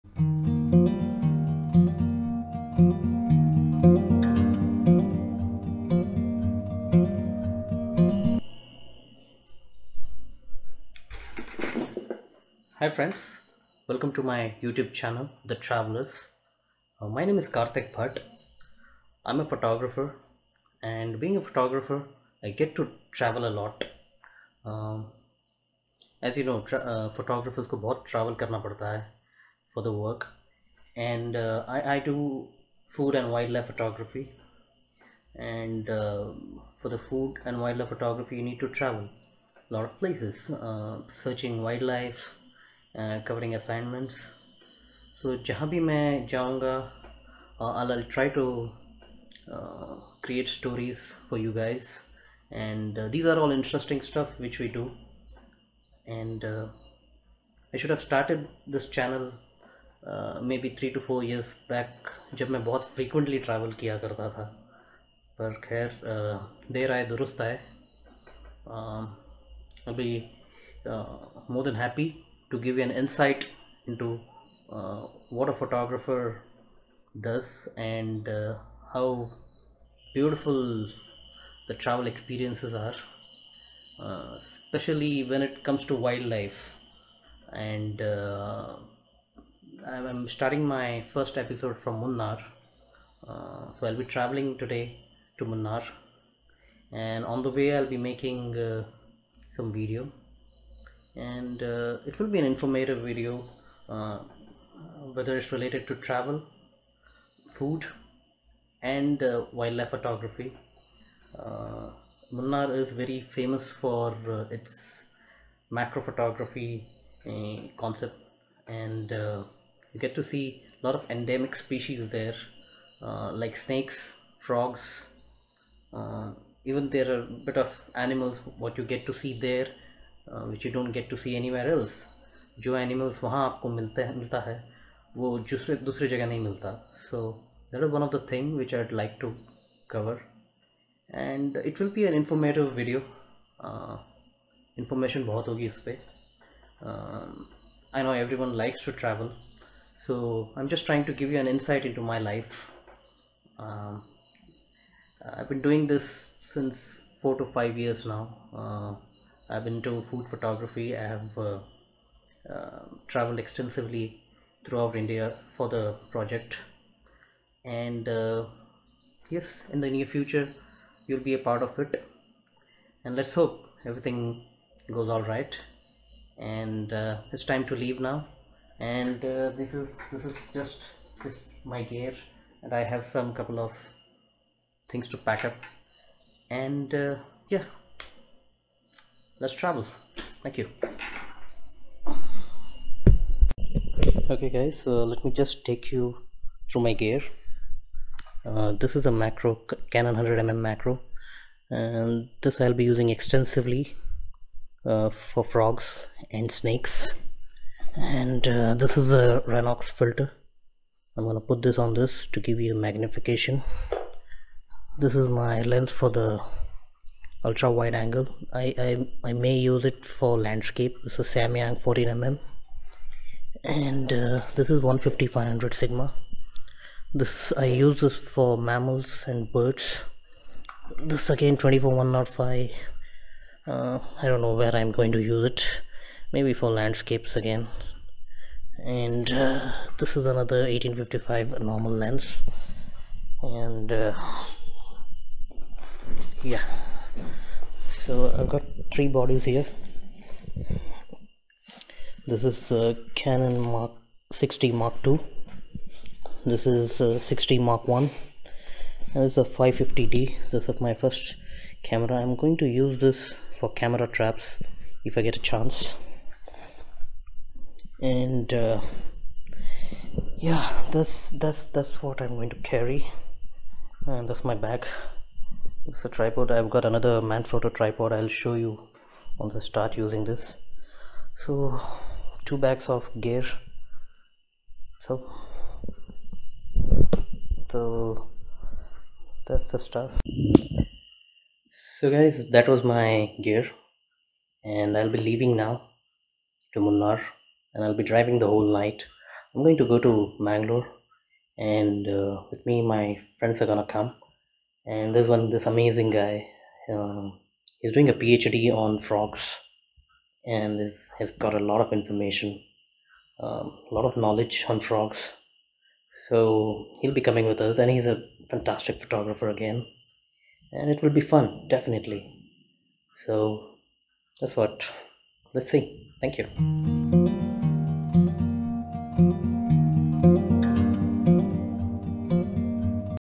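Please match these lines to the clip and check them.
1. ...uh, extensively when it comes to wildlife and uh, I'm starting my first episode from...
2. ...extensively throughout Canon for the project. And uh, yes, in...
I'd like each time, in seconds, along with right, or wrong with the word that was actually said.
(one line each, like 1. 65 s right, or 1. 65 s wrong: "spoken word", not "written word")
1. 84 s wrong: "especially", not "extensively"
2. 163 s wrong: "India", not "Canon".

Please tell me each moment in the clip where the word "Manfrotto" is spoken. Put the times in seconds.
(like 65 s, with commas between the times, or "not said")
277 s.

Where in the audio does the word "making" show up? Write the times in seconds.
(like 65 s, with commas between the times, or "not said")
97 s.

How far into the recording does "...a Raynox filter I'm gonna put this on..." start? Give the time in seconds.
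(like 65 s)
209 s.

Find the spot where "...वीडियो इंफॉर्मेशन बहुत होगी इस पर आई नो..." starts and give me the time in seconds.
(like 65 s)
142 s.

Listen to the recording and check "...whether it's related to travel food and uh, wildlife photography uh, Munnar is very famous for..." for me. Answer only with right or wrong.
right.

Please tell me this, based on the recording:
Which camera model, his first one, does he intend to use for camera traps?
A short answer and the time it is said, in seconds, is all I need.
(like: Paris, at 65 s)
550D, at 259 s.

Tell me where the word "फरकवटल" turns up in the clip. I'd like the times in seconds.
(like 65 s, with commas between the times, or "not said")
62 s.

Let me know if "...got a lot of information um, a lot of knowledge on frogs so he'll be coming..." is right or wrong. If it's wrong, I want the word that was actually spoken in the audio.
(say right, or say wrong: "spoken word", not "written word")
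right.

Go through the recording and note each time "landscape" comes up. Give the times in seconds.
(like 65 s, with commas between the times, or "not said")
220 s, 236 s.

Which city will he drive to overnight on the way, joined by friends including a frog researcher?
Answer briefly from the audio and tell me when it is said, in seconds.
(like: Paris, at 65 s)
Mangalore, at 300 s.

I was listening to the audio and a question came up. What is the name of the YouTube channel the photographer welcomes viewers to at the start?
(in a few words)
The Travelers.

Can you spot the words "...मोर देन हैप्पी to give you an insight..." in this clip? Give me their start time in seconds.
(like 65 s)
70 s.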